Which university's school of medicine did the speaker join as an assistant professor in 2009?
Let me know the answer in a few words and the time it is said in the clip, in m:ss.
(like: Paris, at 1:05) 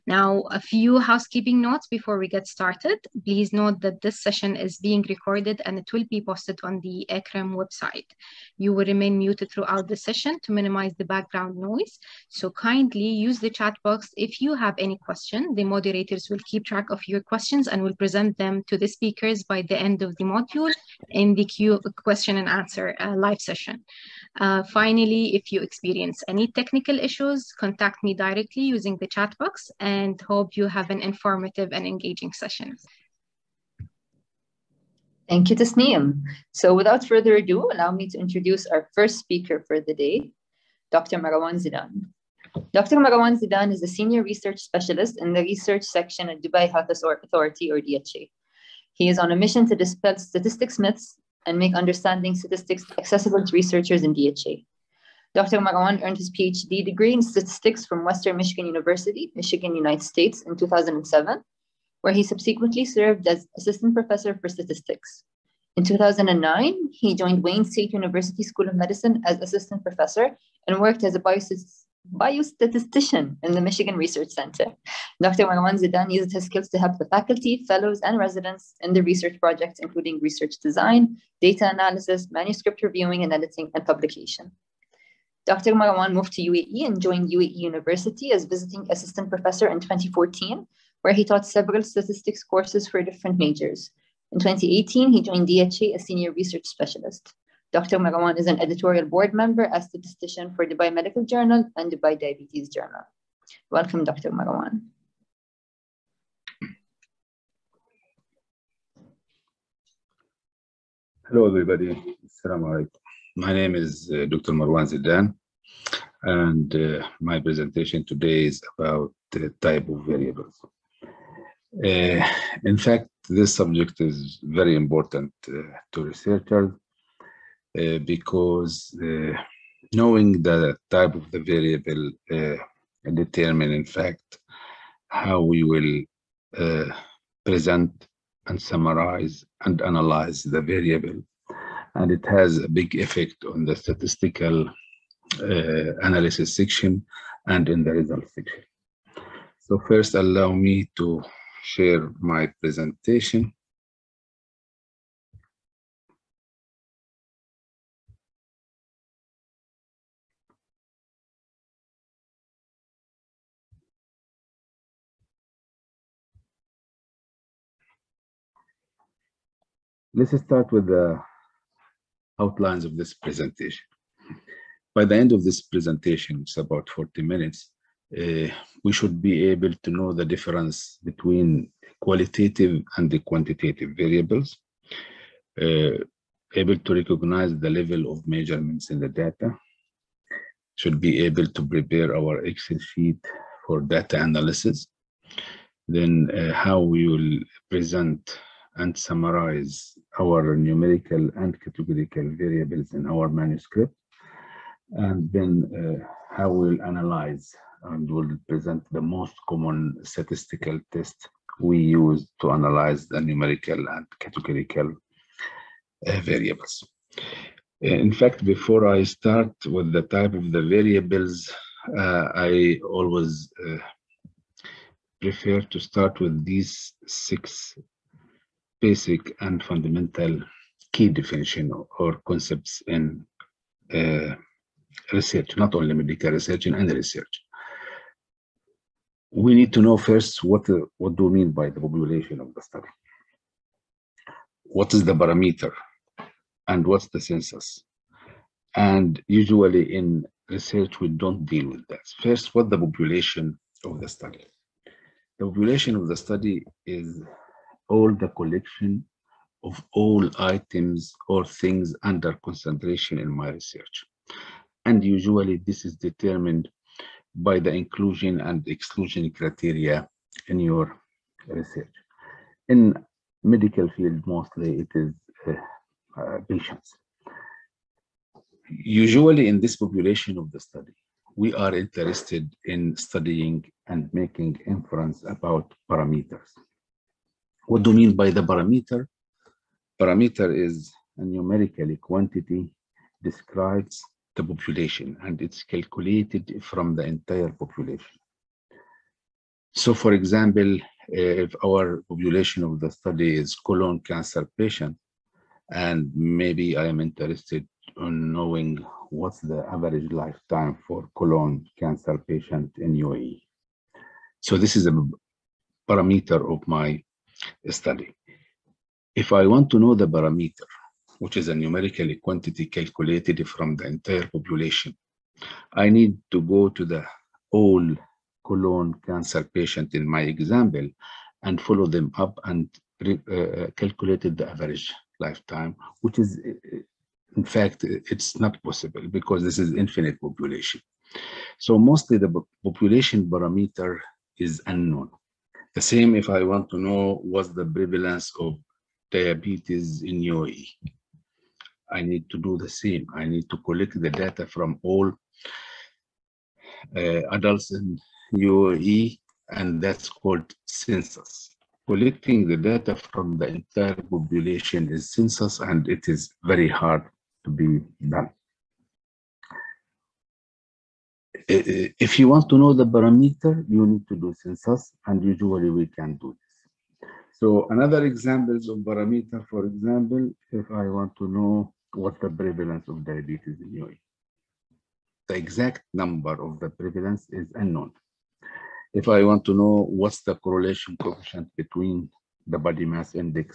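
Wayne State University, at 1:07.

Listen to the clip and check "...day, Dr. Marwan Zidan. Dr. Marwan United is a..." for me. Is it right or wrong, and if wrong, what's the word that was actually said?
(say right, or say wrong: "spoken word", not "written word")
wrong: "Zidan", not "United".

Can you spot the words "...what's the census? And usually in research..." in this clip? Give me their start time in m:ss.
4:06.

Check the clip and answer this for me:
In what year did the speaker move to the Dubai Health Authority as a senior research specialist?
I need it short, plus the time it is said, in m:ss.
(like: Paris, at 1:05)
2018, at 1:34.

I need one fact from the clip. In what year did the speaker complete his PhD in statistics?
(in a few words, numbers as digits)
2007.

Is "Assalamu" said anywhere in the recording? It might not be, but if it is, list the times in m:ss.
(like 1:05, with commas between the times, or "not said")
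1:52.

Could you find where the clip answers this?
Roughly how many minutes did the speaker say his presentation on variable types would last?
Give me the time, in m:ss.
2:56.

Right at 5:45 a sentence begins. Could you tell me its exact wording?
The same if I want to know what's the prevalence of diabetes in UAE.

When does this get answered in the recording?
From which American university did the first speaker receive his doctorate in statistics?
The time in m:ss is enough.
0:58.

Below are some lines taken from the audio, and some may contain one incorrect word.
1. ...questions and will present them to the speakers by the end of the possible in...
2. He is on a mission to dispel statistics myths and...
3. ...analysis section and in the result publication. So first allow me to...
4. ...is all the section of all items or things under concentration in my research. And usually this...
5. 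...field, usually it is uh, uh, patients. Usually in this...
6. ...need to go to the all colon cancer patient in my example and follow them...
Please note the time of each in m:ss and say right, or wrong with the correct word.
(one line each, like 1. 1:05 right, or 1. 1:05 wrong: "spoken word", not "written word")
1. 0:17 wrong: "module", not "possible"
2. 0:48 right
3. 2:26 wrong: "section", not "publication"
4. 4:16 wrong: "collection", not "section"
5. 4:33 wrong: "mostly", not "usually"
6. 5:25 right.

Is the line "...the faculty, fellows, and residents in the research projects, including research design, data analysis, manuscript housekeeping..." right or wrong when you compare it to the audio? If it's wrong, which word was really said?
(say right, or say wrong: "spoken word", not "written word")
wrong: "reviewing", not "housekeeping".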